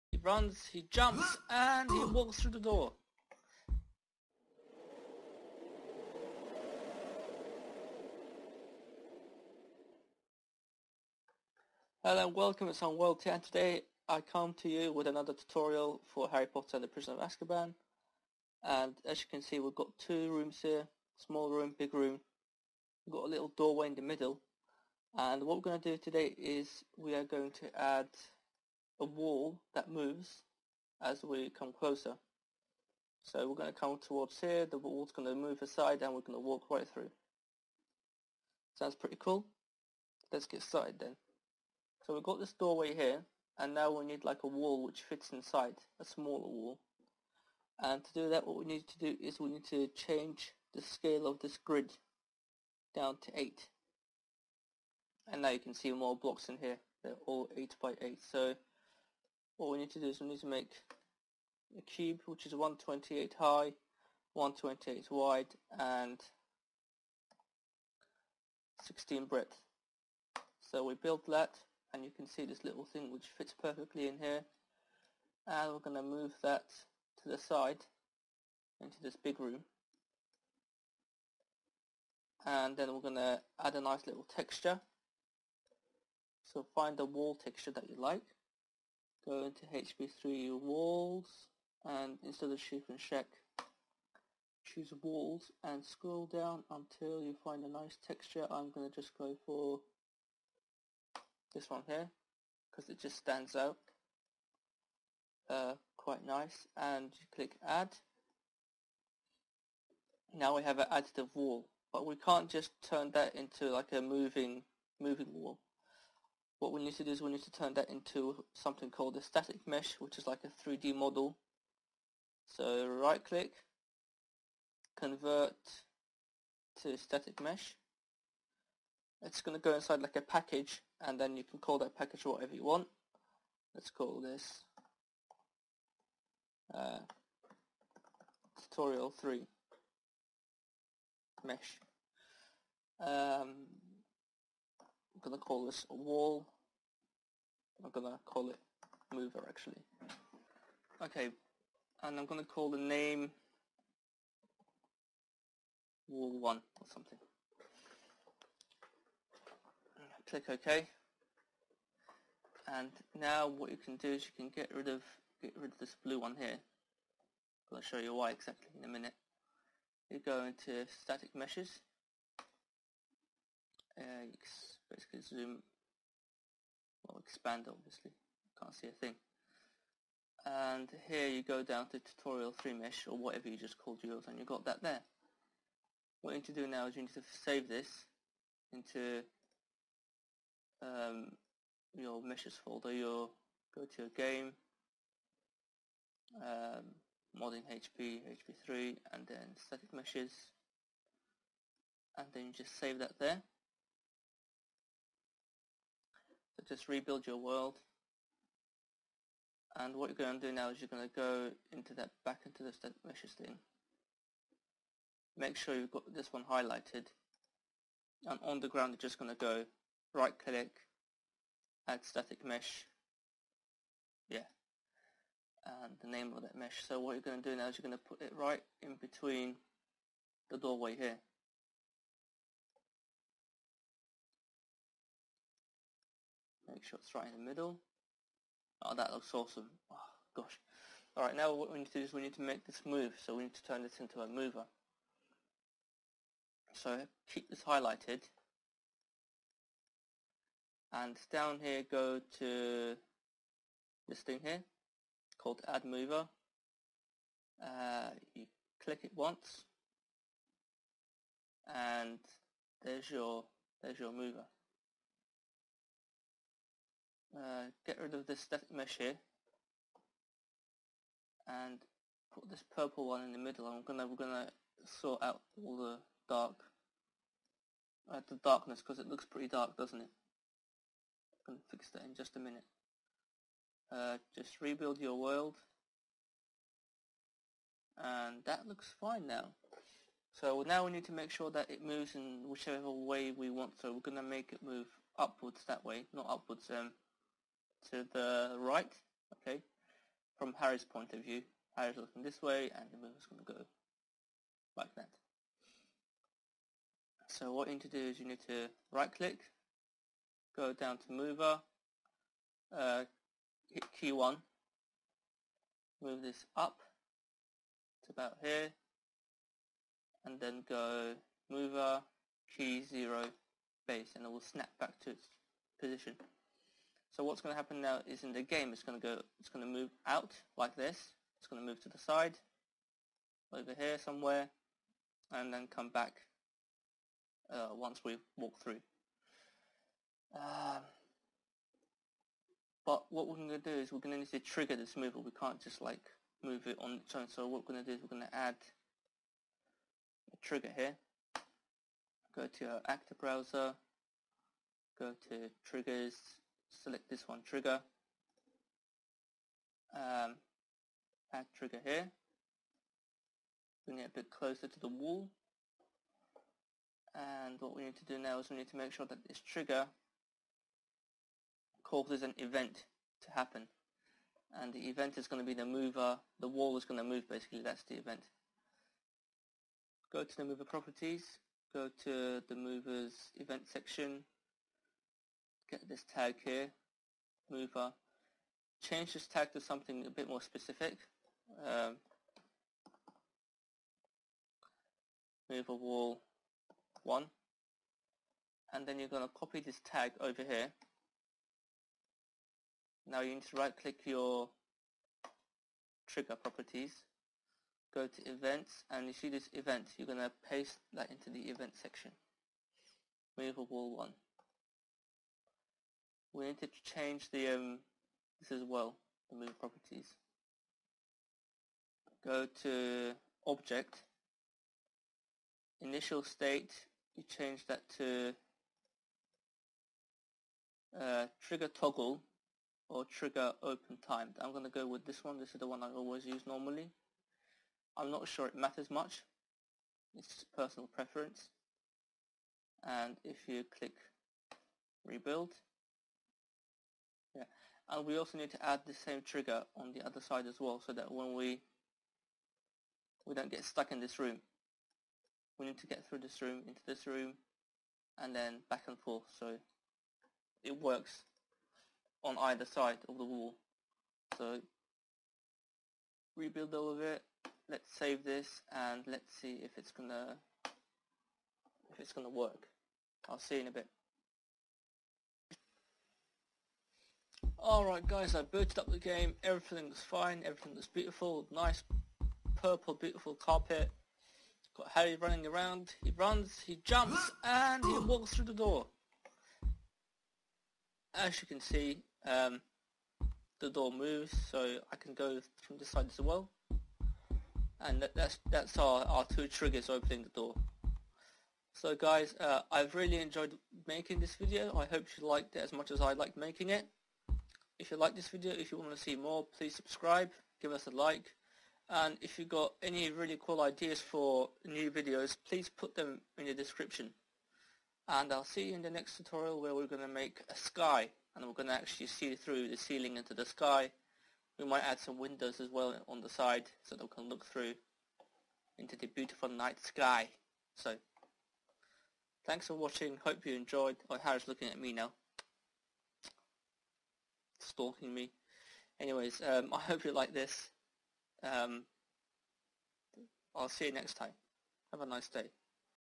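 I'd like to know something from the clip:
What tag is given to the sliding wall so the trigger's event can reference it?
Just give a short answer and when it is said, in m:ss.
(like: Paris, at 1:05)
mover wall 1, at 6:35.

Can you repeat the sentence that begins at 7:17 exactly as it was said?
I'm not sure it matters much, it's just personal preference.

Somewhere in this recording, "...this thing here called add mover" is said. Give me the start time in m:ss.
4:14.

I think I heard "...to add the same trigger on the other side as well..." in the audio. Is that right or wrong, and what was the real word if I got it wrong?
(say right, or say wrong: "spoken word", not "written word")
right.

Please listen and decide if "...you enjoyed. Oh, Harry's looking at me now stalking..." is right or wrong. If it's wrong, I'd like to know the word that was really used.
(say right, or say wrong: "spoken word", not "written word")
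right.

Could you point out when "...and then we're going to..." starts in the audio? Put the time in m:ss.
1:22.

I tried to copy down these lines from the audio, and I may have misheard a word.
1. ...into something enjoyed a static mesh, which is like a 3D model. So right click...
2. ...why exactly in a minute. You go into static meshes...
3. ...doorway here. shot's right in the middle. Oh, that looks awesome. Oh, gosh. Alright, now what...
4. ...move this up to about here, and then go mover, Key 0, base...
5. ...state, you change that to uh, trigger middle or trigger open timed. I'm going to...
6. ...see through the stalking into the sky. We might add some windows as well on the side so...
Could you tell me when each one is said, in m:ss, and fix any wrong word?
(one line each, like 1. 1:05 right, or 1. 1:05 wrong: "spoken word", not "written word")
1. 1:57 wrong: "called", not "enjoyed"
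2. 2:48 right
3. 3:50 right
4. 5:16 right
5. 7:06 wrong: "toggle", not "middle"
6. 8:42 wrong: "ceiling", not "stalking".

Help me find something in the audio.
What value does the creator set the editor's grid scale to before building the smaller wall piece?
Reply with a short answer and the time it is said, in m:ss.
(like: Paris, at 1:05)
8, at 0:52.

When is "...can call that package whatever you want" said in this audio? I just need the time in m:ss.
2:11.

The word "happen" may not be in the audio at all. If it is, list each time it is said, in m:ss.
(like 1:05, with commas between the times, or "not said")
5:27, 6:13.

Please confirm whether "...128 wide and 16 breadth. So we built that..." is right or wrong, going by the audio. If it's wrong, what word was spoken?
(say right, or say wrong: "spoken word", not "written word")
right.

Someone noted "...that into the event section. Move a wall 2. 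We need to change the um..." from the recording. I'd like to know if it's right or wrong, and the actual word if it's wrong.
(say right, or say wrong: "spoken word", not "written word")
wrong: "1", not "2".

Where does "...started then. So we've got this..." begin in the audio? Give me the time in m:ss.
0:40.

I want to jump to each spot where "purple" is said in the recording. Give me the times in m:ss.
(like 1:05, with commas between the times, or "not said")
4:32, 8:02.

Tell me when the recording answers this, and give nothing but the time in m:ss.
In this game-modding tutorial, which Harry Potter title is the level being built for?
0:16.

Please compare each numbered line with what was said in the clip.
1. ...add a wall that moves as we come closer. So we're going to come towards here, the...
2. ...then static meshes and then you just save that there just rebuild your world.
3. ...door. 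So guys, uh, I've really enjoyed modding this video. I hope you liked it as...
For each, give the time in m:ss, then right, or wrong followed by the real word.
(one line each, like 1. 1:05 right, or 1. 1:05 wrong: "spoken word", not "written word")
1. 0:27 right
2. 3:19 right
3. 8:20 wrong: "making", not "modding".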